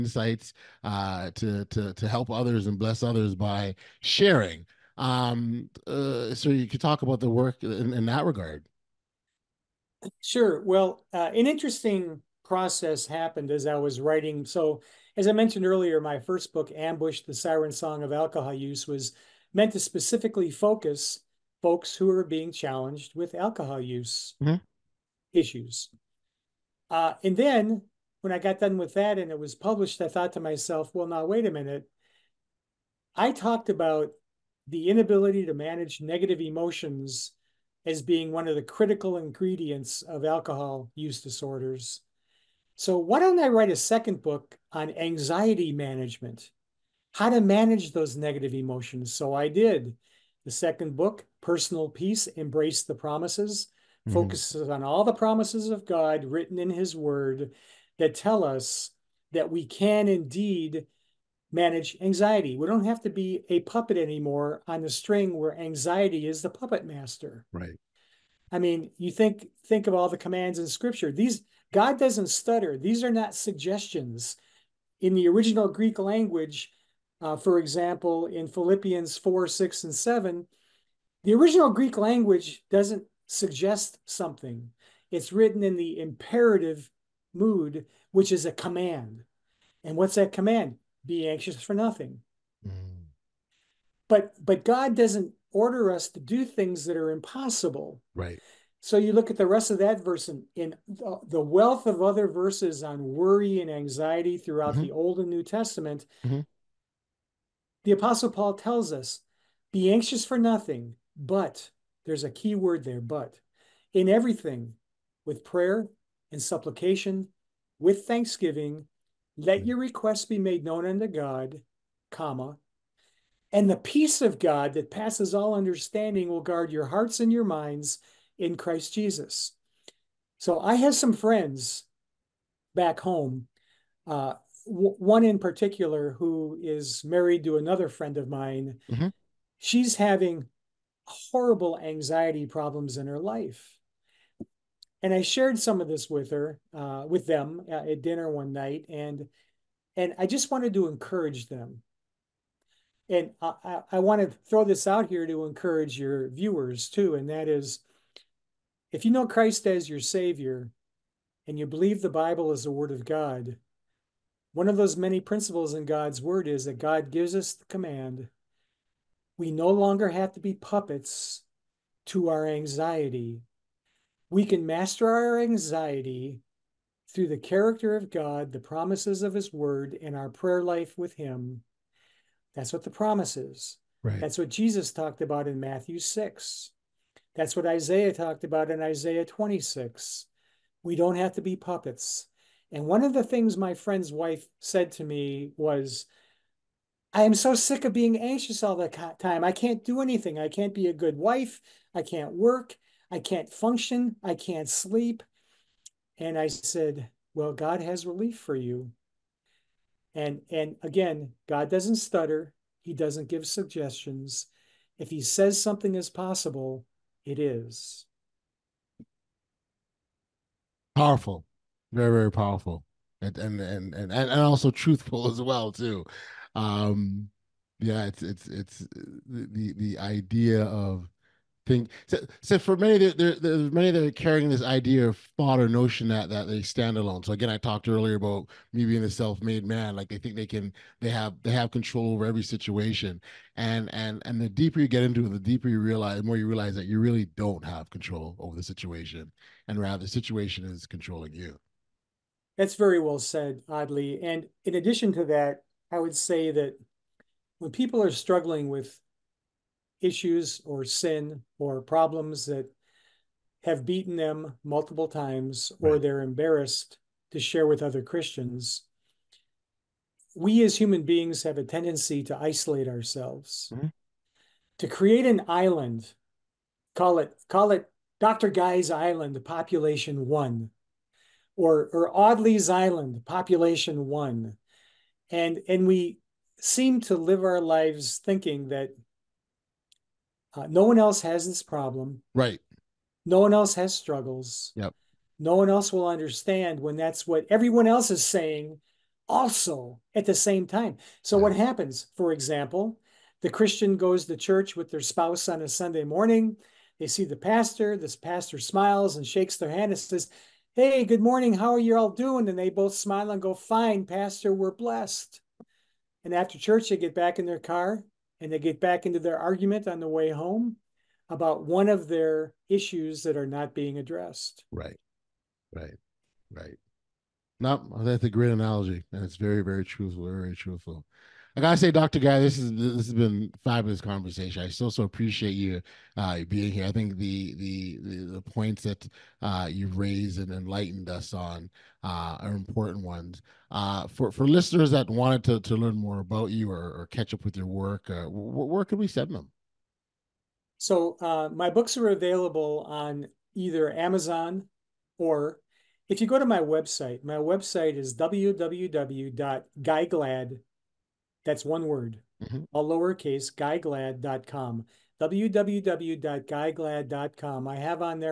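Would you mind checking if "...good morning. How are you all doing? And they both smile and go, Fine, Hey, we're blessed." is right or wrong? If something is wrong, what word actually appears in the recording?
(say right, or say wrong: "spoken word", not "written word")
wrong: "Pastor", not "Hey".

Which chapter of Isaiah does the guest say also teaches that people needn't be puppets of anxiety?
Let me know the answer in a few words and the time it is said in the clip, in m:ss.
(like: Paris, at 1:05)
Isaiah 26, at 3:08.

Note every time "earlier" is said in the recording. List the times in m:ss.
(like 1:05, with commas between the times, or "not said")
0:15, 3:57.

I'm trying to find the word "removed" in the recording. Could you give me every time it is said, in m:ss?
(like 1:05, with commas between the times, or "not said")
not said.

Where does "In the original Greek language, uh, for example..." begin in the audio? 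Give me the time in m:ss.
1:15.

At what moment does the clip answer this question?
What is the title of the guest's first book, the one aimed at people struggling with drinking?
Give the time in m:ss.
0:16.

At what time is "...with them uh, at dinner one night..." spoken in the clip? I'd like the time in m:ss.
2:27.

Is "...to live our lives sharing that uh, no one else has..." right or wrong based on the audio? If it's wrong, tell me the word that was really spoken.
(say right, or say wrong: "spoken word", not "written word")
wrong: "thinking", not "sharing".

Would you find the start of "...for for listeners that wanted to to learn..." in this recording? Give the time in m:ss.
5:44.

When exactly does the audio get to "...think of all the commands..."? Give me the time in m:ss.
1:09.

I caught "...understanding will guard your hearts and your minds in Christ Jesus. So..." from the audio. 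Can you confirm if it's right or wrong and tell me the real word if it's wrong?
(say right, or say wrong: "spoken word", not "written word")
right.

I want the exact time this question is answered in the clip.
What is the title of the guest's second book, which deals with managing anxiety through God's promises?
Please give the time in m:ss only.
0:51.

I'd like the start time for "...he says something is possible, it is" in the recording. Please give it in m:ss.
3:35.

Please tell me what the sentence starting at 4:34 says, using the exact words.
to create an island, call it call it Dr.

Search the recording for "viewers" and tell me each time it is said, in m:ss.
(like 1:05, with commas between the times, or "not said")
2:36.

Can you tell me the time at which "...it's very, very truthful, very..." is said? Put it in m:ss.
5:29.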